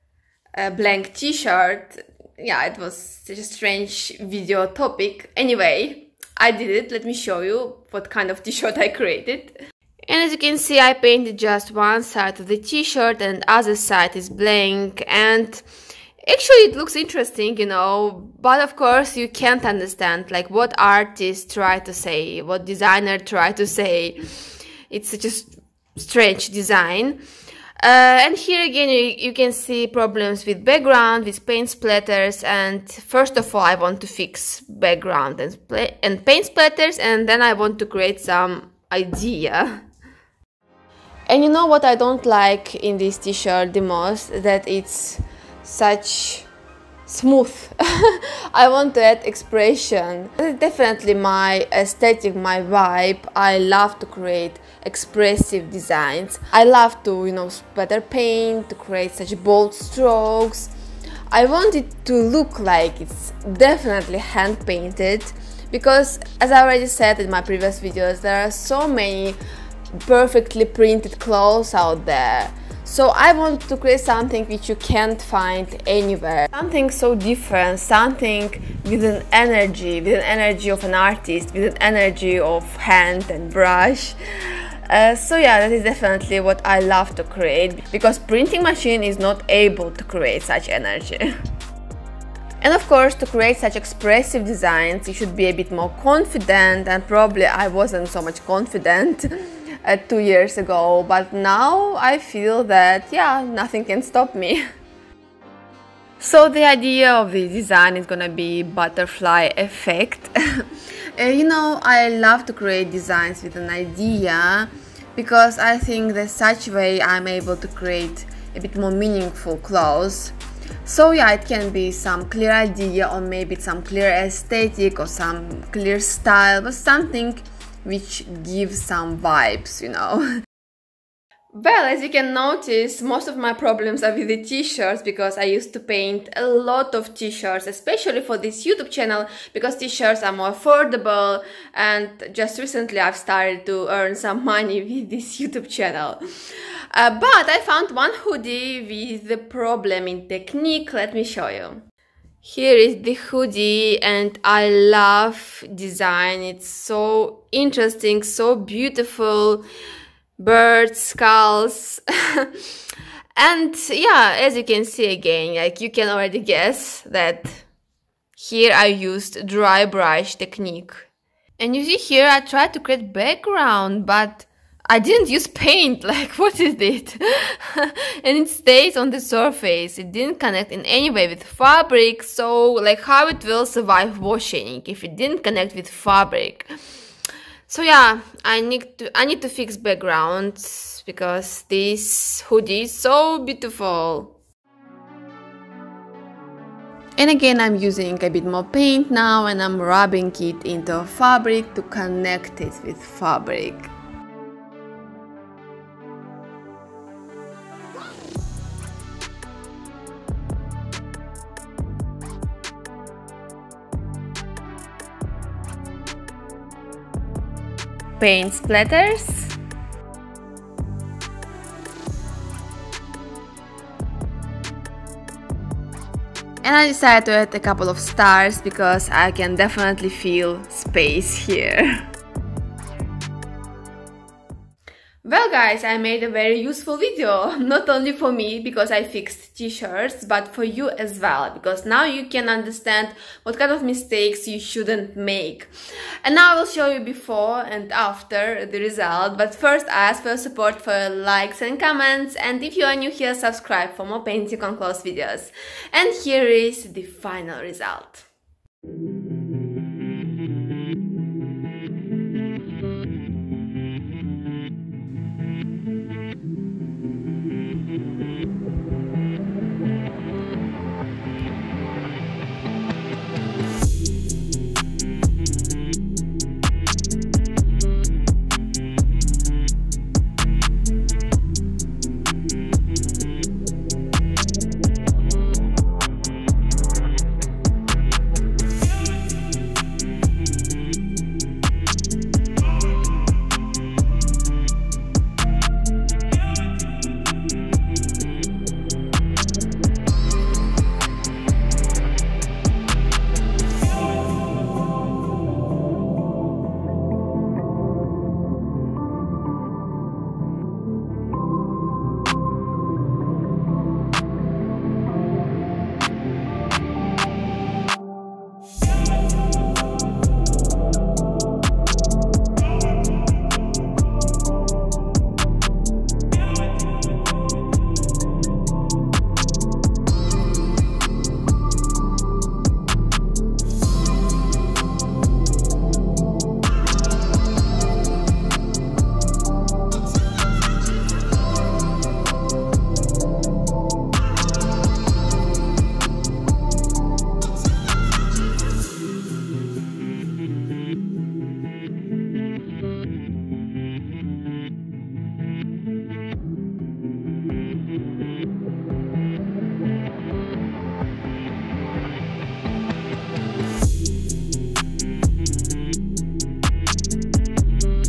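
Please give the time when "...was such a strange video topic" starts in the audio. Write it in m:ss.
0:02.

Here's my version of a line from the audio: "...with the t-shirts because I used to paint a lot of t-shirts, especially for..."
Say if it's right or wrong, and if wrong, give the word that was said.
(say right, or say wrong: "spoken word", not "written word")
right.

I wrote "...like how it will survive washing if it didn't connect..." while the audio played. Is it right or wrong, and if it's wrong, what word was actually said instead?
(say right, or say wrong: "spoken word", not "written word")
right.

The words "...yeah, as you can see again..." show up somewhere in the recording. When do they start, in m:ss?
2:43.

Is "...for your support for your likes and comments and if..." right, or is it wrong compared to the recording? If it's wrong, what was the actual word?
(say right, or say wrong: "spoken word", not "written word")
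right.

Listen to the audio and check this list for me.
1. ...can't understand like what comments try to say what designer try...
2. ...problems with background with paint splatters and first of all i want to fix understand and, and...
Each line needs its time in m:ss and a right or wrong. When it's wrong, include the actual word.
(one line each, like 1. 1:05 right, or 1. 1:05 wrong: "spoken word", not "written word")
1. 0:19 wrong: "artists", not "comments"
2. 0:29 wrong: "background", not "understand".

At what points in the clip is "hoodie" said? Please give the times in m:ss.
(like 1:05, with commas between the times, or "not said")
2:28, 2:33, 3:12.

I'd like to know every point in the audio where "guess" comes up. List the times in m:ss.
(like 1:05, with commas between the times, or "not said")
2:46.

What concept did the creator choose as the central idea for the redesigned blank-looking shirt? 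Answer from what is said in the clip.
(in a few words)
Butterfly effect.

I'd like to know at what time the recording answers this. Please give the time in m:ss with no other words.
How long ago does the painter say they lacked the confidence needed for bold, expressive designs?
1:39.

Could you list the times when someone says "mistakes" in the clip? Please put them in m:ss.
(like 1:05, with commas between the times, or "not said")
4:03.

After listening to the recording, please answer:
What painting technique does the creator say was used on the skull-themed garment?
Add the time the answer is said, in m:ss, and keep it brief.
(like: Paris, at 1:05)
Dry brush, at 2:49.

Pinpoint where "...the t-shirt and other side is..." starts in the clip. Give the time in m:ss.
0:12.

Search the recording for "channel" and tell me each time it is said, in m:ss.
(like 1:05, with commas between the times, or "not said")
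2:18, 2:25.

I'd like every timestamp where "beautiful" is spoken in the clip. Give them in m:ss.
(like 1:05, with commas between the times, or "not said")
2:38, 3:13.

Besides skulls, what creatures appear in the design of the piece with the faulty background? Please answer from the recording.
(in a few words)
Birds.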